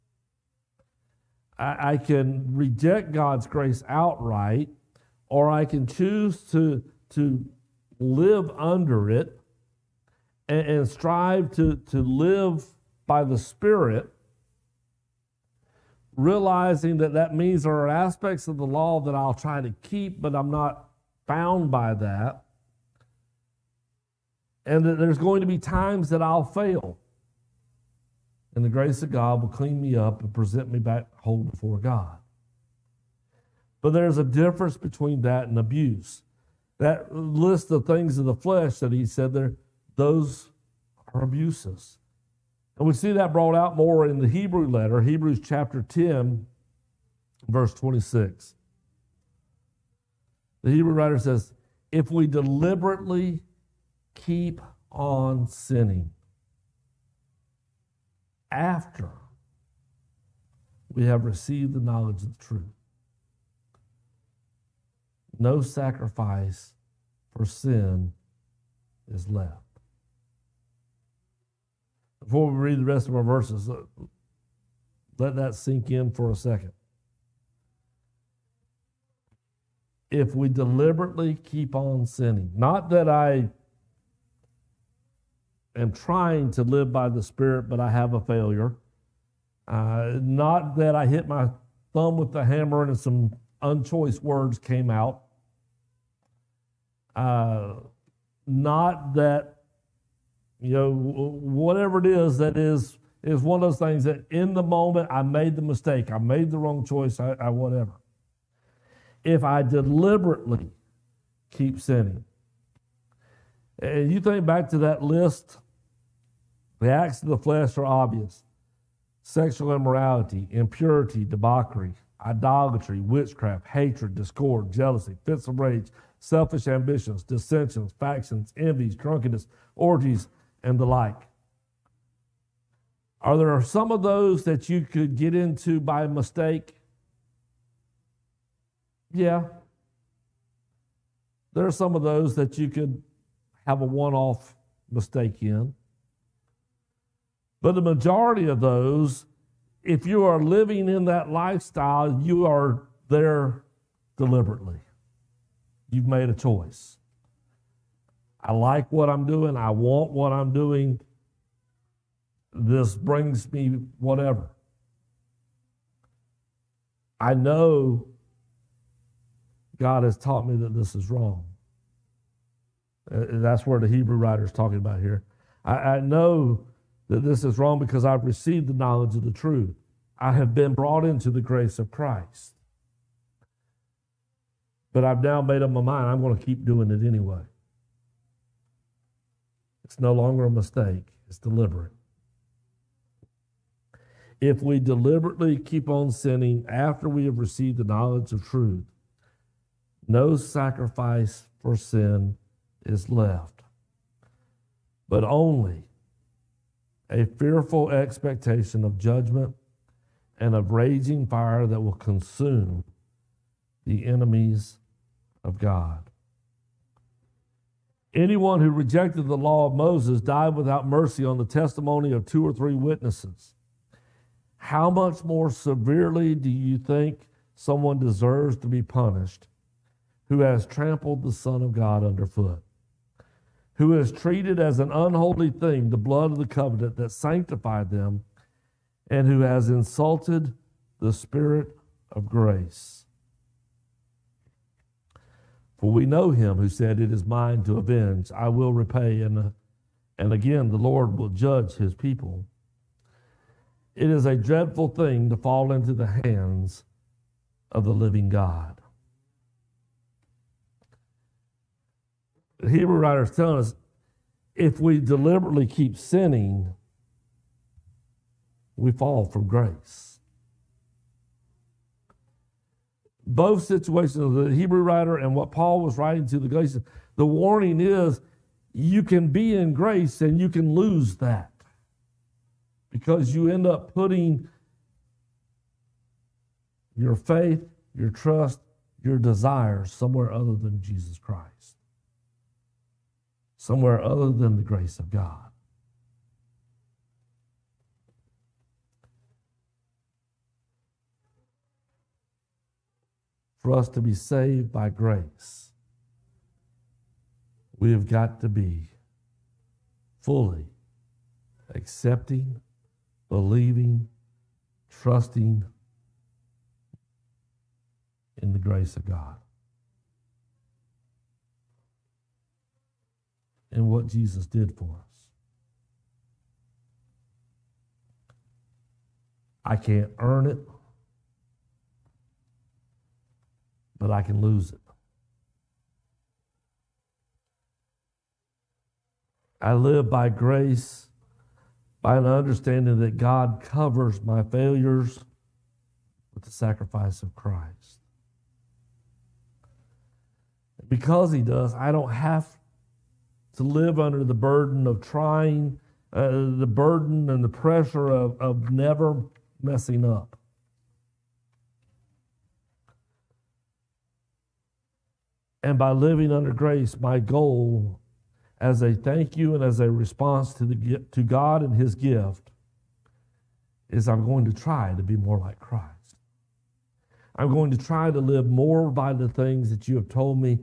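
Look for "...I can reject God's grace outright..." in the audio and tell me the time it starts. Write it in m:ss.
0:01.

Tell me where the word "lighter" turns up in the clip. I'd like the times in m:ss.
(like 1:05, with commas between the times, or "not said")
not said.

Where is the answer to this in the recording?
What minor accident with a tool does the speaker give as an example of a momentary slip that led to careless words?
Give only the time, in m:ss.
1:31.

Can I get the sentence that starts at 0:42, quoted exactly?
And we see that brought out more in the Hebrew letter, Hebrews chapter 10, verse 26.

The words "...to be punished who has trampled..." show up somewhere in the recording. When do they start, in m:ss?
3:48.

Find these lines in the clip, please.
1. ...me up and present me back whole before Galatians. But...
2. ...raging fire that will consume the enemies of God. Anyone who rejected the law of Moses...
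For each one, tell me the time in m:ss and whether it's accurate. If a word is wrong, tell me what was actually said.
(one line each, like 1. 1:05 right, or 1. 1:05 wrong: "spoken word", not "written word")
1. 0:29 wrong: "God", not "Galatians"
2. 3:30 right.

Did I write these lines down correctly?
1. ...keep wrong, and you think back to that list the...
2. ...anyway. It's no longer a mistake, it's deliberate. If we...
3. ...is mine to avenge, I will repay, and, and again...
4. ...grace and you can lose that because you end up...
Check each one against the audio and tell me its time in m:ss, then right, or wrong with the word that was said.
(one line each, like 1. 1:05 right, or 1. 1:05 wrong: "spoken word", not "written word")
1. 1:51 wrong: "sinning", not "wrong"
2. 3:07 right
3. 4:07 right
4. 4:39 right.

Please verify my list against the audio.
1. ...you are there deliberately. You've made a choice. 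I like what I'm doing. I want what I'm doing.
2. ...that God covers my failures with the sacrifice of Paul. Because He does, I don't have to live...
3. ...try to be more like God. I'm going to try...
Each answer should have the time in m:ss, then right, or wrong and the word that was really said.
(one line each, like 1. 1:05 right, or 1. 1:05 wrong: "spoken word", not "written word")
1. 2:32 right
2. 5:42 wrong: "Christ", not "Paul"
3. 6:14 wrong: "Christ", not "God".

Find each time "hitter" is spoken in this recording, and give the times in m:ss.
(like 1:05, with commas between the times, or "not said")
not said.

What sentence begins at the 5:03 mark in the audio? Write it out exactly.
For us to be saved by grace, we have got to be fully accepting, believing, trusting in the grace of God.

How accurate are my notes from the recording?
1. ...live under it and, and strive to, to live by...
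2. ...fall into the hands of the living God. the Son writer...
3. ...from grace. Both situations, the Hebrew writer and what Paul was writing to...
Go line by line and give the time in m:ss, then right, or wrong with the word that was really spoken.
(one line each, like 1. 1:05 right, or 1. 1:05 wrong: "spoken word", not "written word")
1. 0:07 right
2. 4:15 wrong: "Hebrew", not "Son"
3. 4:29 right.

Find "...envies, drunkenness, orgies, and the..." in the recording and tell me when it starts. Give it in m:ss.
2:08.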